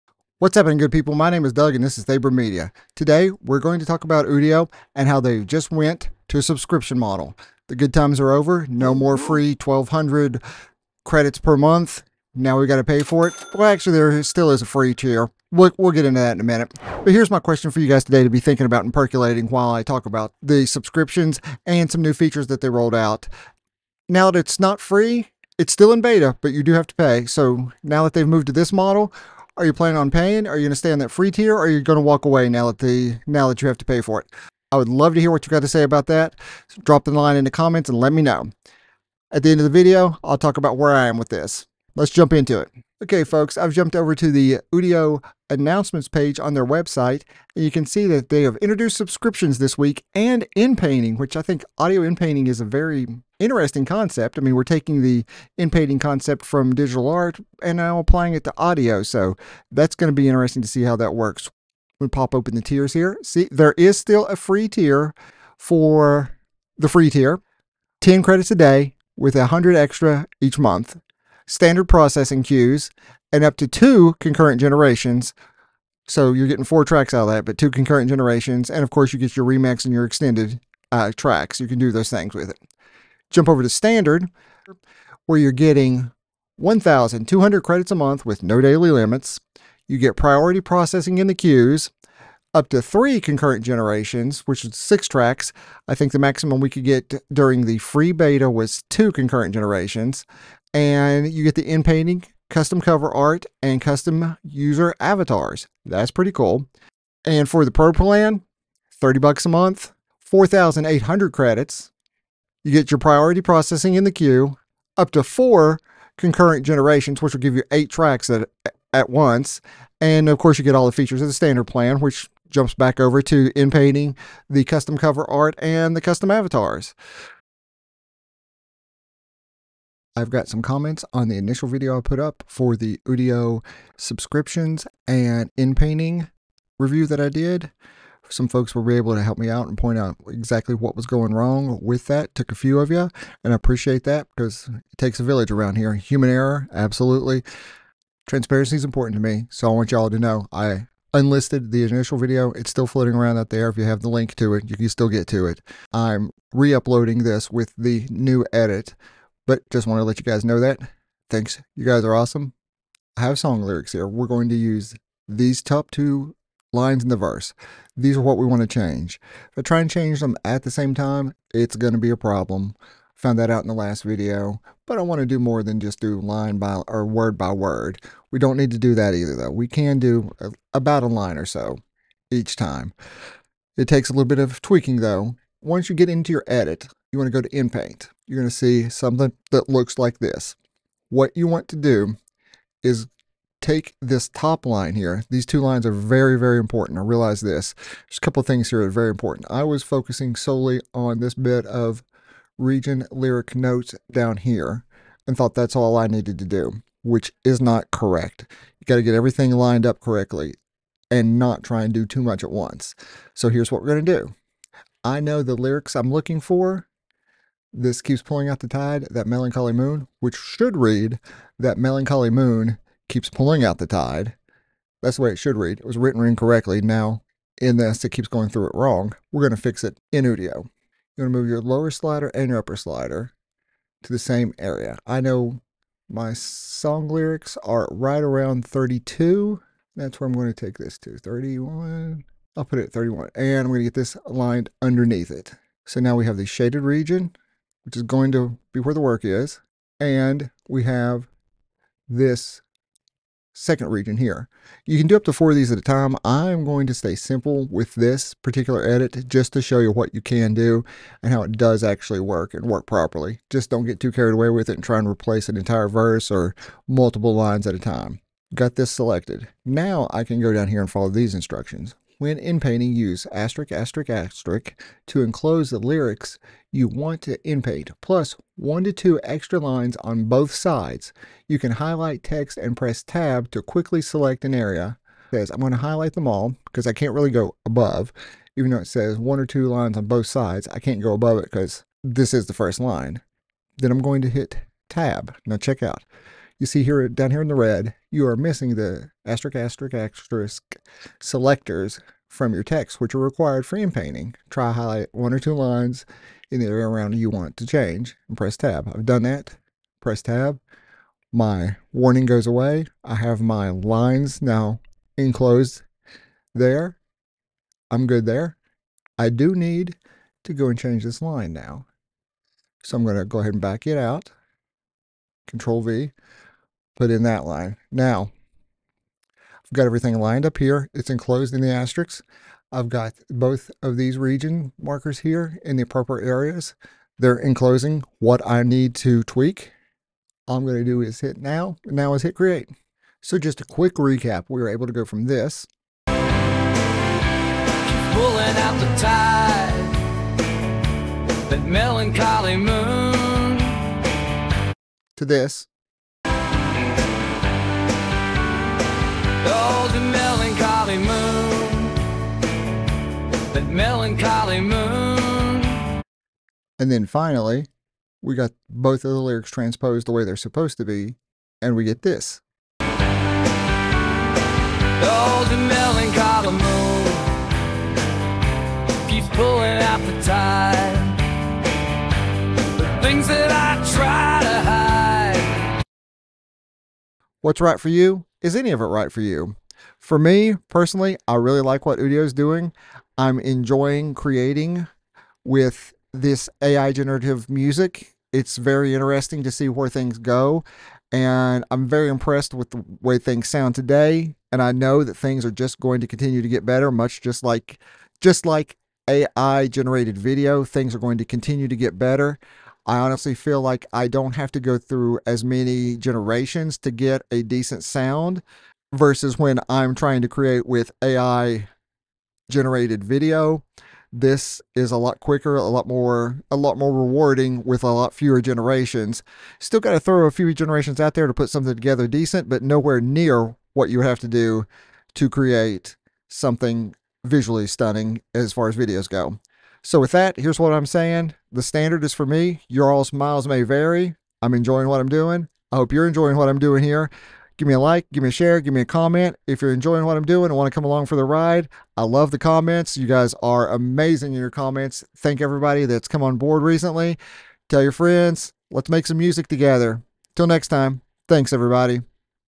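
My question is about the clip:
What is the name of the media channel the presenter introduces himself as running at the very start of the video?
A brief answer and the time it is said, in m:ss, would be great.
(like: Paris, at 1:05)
Thaebrym Media, at 0:02.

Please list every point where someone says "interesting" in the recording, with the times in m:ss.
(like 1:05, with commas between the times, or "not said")
0:53, 1:00, 6:38.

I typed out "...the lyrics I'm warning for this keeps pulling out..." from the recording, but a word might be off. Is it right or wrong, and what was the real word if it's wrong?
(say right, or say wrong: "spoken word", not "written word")
wrong: "looking", not "warning".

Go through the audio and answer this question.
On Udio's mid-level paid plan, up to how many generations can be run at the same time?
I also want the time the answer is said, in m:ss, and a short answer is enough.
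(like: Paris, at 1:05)
3, at 1:32.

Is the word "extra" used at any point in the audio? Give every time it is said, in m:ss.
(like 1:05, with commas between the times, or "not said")
1:09, 4:39.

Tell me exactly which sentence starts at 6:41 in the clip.
And I'm very impressed with the way things sound today.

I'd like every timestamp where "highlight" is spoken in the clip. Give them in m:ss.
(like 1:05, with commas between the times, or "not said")
4:41, 4:45, 5:04.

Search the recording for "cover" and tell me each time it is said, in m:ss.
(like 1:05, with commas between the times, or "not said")
1:42, 2:04.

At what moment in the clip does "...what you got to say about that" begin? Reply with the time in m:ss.
0:35.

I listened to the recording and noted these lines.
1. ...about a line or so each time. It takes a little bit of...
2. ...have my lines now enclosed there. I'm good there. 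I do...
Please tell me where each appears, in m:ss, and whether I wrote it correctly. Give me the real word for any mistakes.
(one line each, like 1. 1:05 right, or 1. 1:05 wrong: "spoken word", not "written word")
1. 3:00 right
2. 5:13 right.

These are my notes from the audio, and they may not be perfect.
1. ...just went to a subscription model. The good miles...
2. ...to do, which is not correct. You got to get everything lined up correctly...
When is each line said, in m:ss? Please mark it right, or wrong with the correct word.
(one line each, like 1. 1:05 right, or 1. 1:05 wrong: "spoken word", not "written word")
1. 0:05 wrong: "times", not "miles"
2. 3:26 right.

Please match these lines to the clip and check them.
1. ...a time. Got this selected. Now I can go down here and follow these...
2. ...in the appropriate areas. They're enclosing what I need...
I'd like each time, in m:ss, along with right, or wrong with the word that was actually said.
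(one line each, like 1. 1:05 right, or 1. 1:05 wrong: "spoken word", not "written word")
1. 4:27 right
2. 5:35 right.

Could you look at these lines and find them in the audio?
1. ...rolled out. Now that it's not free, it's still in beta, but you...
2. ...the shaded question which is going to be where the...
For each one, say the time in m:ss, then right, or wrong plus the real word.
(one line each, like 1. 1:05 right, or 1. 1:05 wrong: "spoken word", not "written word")
1. 0:22 right
2. 4:06 wrong: "region", not "question".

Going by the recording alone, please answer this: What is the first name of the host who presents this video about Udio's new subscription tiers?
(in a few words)
Doug.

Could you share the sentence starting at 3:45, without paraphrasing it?
That's the way it should read.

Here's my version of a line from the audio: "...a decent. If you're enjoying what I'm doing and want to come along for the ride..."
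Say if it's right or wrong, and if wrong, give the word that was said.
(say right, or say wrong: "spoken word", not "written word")
wrong: "comment", not "decent".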